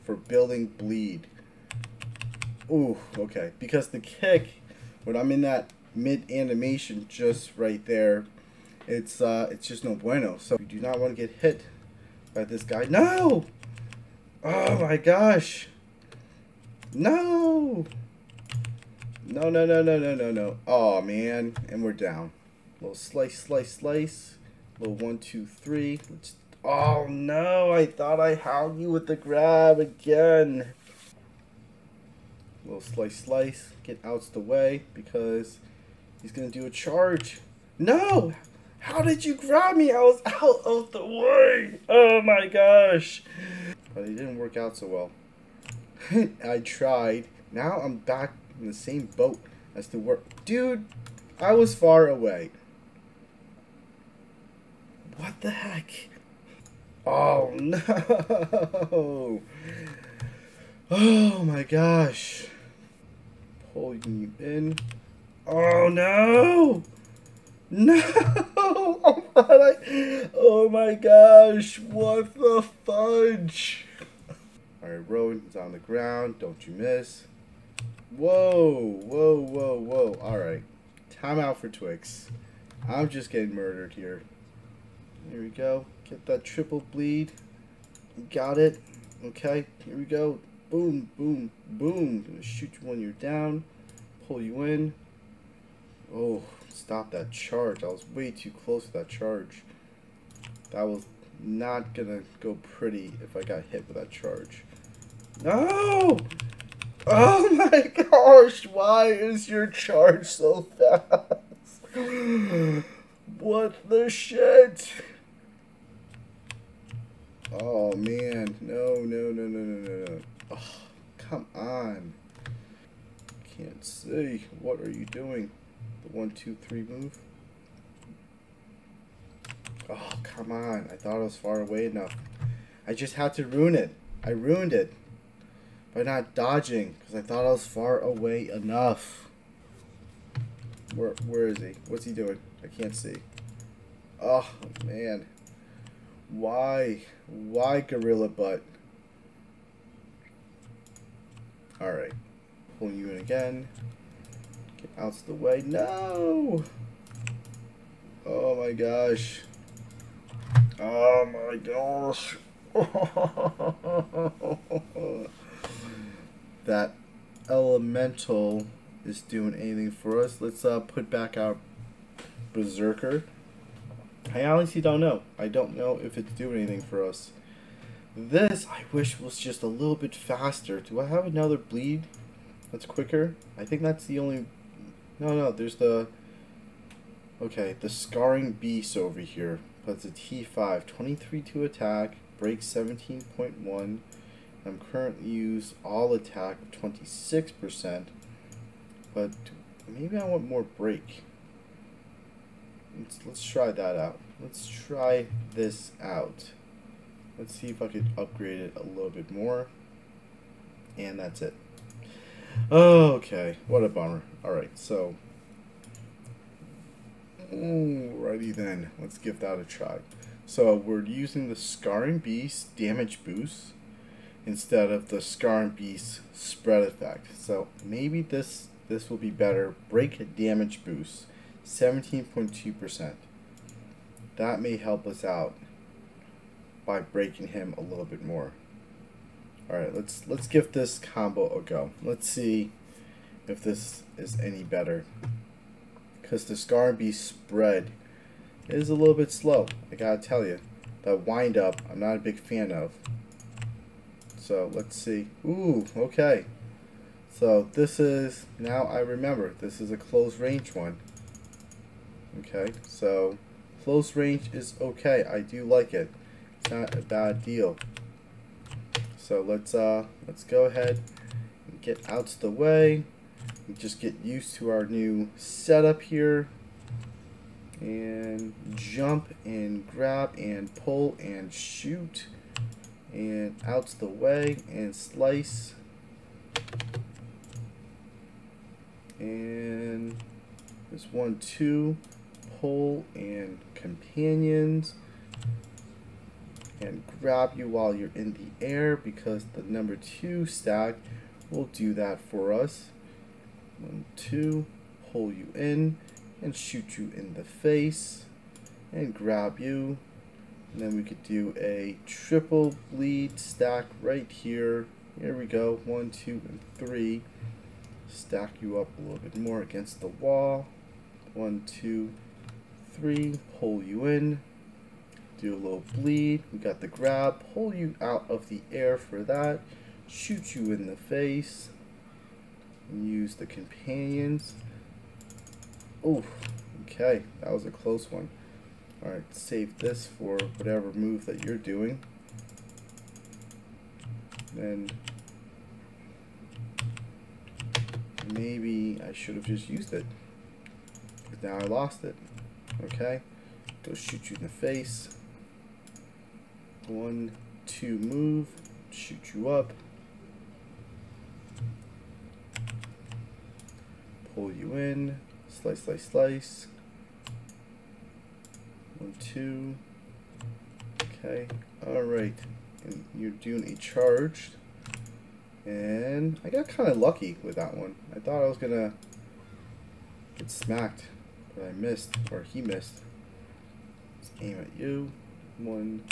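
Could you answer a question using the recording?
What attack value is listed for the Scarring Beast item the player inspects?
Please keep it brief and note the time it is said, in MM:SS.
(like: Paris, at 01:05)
23, at 03:10.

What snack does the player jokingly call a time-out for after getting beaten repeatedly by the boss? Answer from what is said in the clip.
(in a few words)
Twix.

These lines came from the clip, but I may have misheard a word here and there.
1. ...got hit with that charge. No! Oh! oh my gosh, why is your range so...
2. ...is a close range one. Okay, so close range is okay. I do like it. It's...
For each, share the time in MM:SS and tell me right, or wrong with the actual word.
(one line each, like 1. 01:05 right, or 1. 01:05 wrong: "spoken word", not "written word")
1. 01:43 wrong: "charge", not "range"
2. 04:19 right.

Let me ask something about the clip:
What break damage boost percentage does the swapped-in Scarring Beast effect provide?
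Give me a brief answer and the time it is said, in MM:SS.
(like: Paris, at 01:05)
17.2%, at 03:51.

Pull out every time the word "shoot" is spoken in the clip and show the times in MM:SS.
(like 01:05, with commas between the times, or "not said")
01:32, 04:41, 05:06, 05:30, 05:53, 05:58.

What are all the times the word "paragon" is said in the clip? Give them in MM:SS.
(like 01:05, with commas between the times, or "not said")
not said.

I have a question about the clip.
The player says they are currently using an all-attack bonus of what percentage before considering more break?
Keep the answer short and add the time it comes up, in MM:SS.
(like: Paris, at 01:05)
26%, at 03:16.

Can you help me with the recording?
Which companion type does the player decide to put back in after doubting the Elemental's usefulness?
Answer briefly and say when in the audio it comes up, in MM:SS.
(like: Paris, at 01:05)
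Berserker, at 02:52.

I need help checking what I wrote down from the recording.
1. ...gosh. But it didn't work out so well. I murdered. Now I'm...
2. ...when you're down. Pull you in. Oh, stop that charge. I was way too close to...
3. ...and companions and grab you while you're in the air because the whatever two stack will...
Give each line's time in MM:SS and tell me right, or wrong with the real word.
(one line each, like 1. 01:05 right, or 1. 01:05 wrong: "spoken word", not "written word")
1. 00:42 wrong: "tried", not "murdered"
2. 01:32 right
3. 04:53 wrong: "number", not "whatever".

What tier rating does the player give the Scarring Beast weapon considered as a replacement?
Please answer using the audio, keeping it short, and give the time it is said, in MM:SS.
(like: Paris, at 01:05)
T5, at 03:10.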